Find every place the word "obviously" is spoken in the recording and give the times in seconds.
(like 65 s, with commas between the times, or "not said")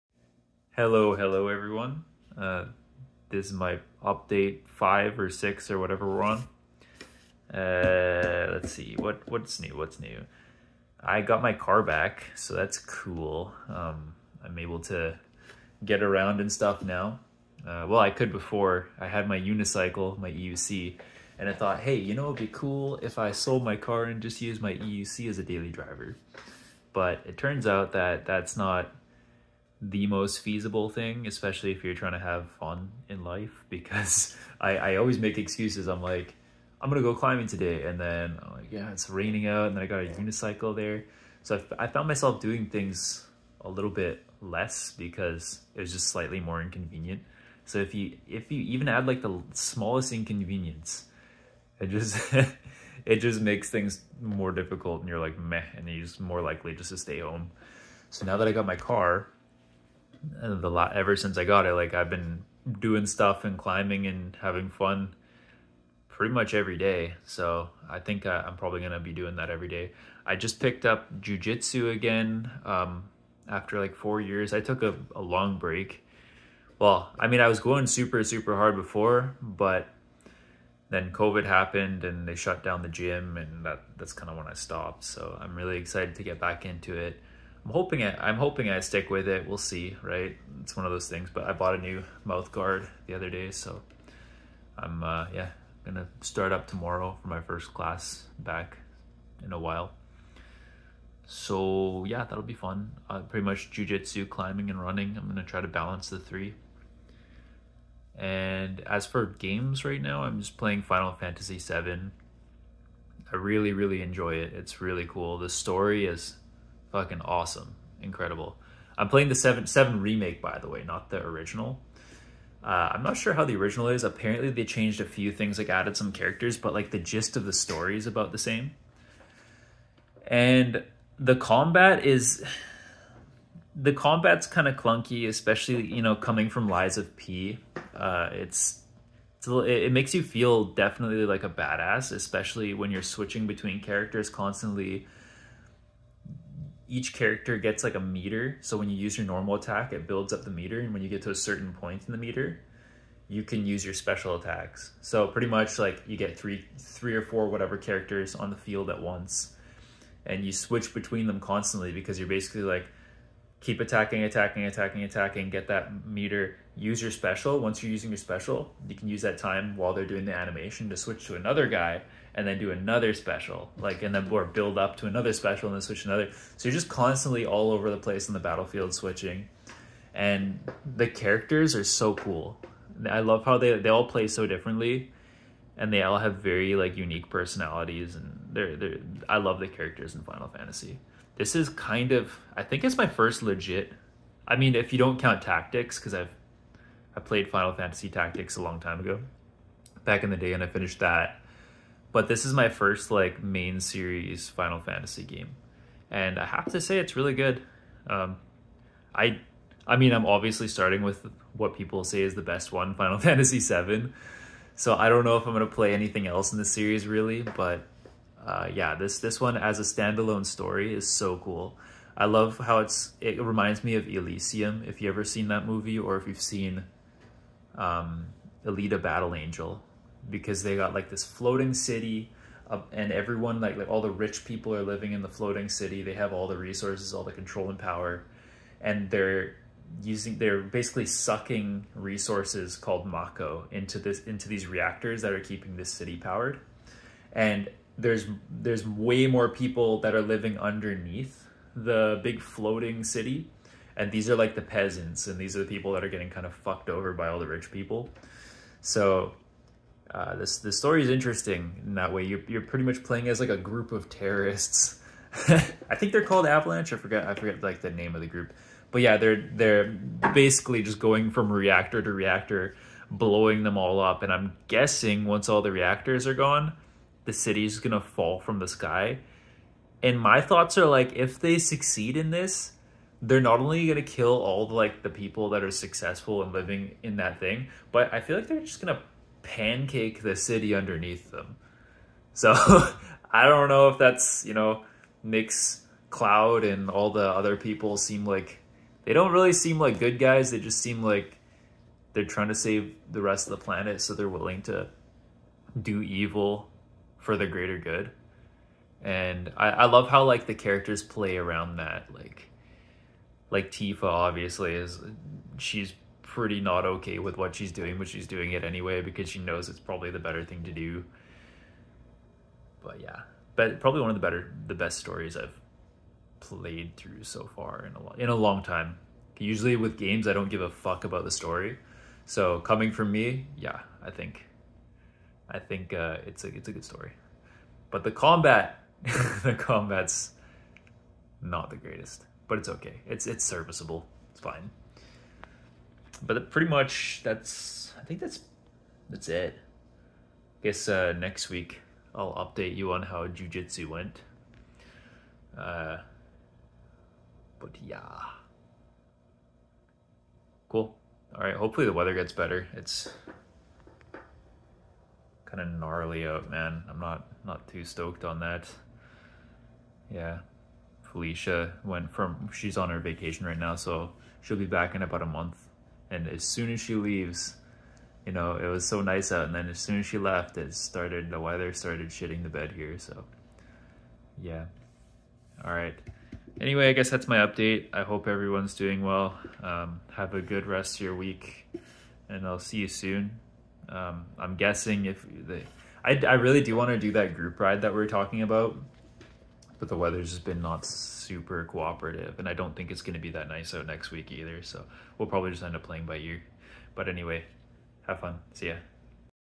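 210 s, 314 s.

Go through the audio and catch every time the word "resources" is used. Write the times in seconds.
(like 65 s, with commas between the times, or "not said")
236 s, 241 s.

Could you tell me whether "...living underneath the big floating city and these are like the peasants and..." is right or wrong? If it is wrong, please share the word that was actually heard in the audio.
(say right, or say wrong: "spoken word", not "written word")
right.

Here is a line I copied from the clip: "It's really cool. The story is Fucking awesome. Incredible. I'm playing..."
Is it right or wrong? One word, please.
right.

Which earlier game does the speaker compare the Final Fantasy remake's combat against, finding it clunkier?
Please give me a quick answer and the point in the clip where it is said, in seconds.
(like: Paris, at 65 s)
Lies of P, at 136 s.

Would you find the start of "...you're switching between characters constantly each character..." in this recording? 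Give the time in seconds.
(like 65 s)
142 s.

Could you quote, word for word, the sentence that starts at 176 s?
So you're just constantly all over the place in the battlefield switching.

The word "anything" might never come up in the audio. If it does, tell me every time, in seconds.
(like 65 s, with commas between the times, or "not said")
215 s.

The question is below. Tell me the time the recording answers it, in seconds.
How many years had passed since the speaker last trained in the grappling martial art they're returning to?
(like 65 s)
73 s.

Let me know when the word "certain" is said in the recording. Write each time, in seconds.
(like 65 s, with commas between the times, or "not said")
151 s.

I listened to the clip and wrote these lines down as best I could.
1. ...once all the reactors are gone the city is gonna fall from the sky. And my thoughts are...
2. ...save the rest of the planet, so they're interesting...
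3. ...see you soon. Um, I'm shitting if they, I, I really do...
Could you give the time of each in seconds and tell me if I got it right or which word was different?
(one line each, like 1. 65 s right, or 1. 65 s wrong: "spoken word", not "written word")
1. 275 s right
2. 302 s wrong: "willing", not "interesting"
3. 392 s wrong: "guessing", not "shitting".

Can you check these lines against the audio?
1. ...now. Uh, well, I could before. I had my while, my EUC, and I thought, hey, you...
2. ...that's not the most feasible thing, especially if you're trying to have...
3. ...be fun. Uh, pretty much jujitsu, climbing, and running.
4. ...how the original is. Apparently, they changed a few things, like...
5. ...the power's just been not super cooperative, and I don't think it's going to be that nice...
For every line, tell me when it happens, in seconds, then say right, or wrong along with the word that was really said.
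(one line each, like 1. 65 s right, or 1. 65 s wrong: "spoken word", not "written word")
1. 16 s wrong: "unicycle", not "while"
2. 28 s right
3. 102 s right
4. 123 s right
5. 399 s wrong: "weather", not "power".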